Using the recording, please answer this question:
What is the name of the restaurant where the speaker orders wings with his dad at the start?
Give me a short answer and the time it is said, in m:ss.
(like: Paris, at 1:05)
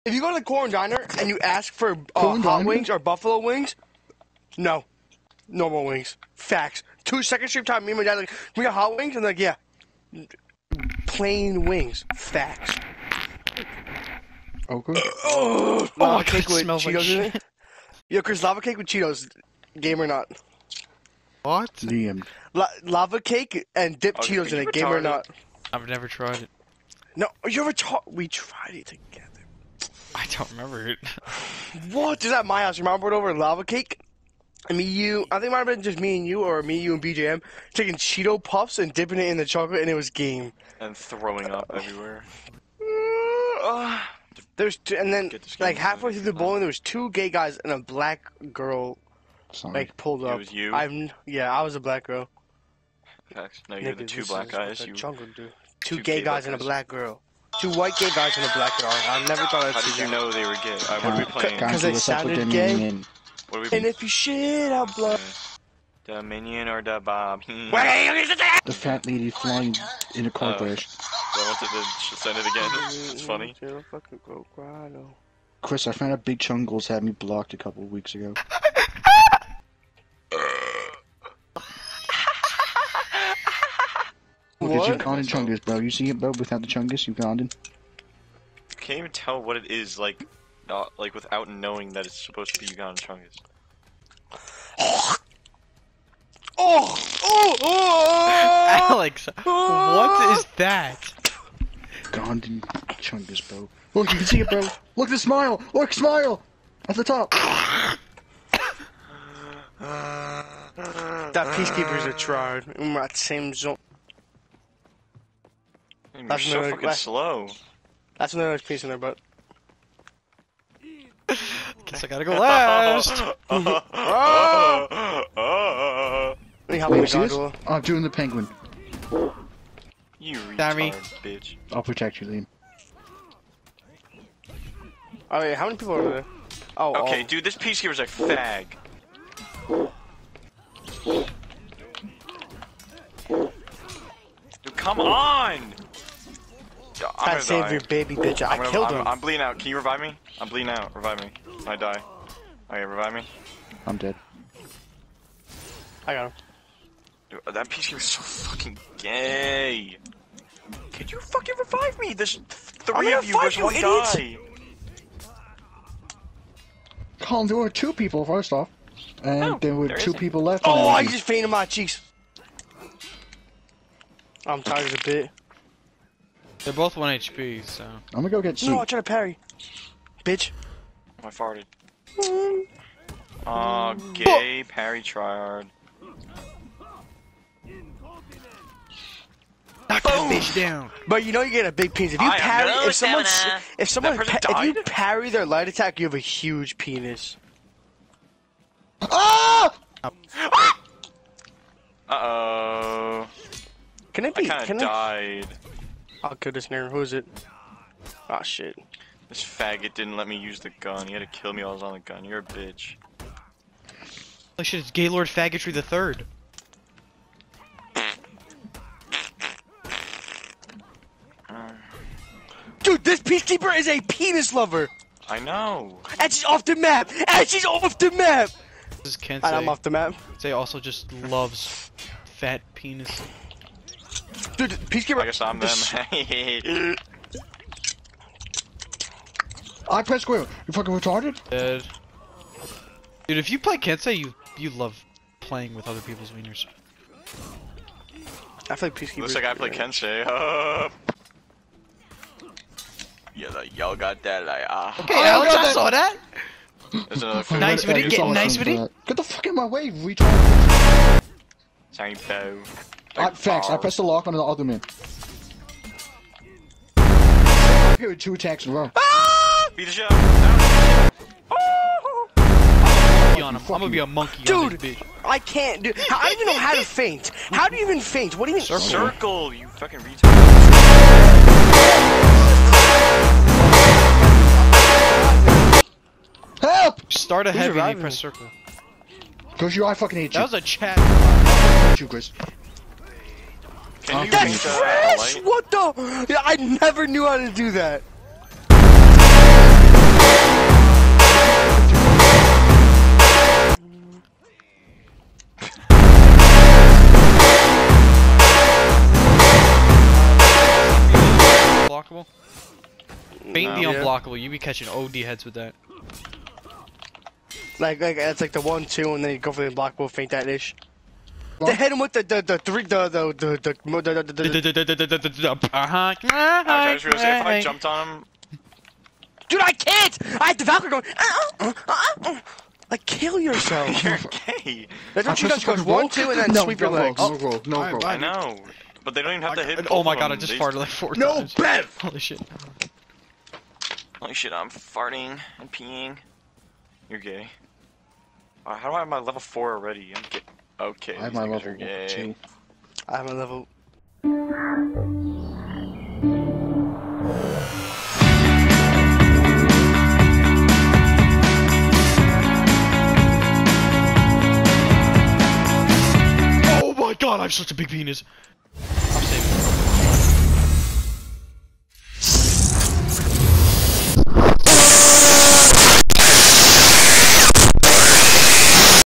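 corn diner, at 0:00.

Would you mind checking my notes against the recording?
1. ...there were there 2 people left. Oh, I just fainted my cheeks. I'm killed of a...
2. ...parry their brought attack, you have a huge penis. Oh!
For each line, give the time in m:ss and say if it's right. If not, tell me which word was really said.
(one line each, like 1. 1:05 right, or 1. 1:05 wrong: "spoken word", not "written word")
1. 2:49 wrong: "tired", not "killed"
2. 3:14 wrong: "light", not "brought".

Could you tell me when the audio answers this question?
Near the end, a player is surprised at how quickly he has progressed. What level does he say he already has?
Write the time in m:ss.
5:49.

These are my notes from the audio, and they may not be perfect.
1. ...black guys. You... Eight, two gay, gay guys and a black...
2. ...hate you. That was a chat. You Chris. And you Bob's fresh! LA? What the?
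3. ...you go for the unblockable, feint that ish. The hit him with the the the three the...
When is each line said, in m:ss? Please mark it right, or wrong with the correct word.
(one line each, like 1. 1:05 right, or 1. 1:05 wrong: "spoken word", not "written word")
1. 0:54 wrong: "Two", not "Eight"
2. 4:50 wrong: "That", not "Bob"
3. 5:19 right.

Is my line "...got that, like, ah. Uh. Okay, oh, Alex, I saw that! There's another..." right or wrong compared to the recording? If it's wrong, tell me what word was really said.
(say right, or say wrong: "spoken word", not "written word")
right.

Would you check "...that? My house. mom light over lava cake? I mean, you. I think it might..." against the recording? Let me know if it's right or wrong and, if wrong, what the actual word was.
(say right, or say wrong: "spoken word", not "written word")
wrong: "brought", not "light".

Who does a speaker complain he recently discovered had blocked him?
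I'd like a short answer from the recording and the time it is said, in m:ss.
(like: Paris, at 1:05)
Big Chungles, at 1:16.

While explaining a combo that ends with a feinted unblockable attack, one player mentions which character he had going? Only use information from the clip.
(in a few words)
Valkyrie.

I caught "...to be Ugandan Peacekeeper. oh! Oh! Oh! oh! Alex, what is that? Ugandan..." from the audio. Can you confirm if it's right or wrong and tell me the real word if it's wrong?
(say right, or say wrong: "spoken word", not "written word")
wrong: "Chungus", not "Peacekeeper".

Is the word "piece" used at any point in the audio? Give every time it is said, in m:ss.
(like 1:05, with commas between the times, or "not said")
1:58, 2:17, 2:37.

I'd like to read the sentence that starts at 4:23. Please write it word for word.
I, thanks, I pressed the lock on the other man.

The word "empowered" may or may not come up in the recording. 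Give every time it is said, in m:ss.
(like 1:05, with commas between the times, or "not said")
not said.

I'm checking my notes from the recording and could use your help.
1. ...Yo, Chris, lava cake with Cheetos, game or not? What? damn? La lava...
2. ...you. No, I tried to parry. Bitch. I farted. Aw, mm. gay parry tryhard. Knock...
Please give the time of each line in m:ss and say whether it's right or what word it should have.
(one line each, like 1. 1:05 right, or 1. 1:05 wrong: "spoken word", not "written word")
1. 0:18 right
2. 2:58 right.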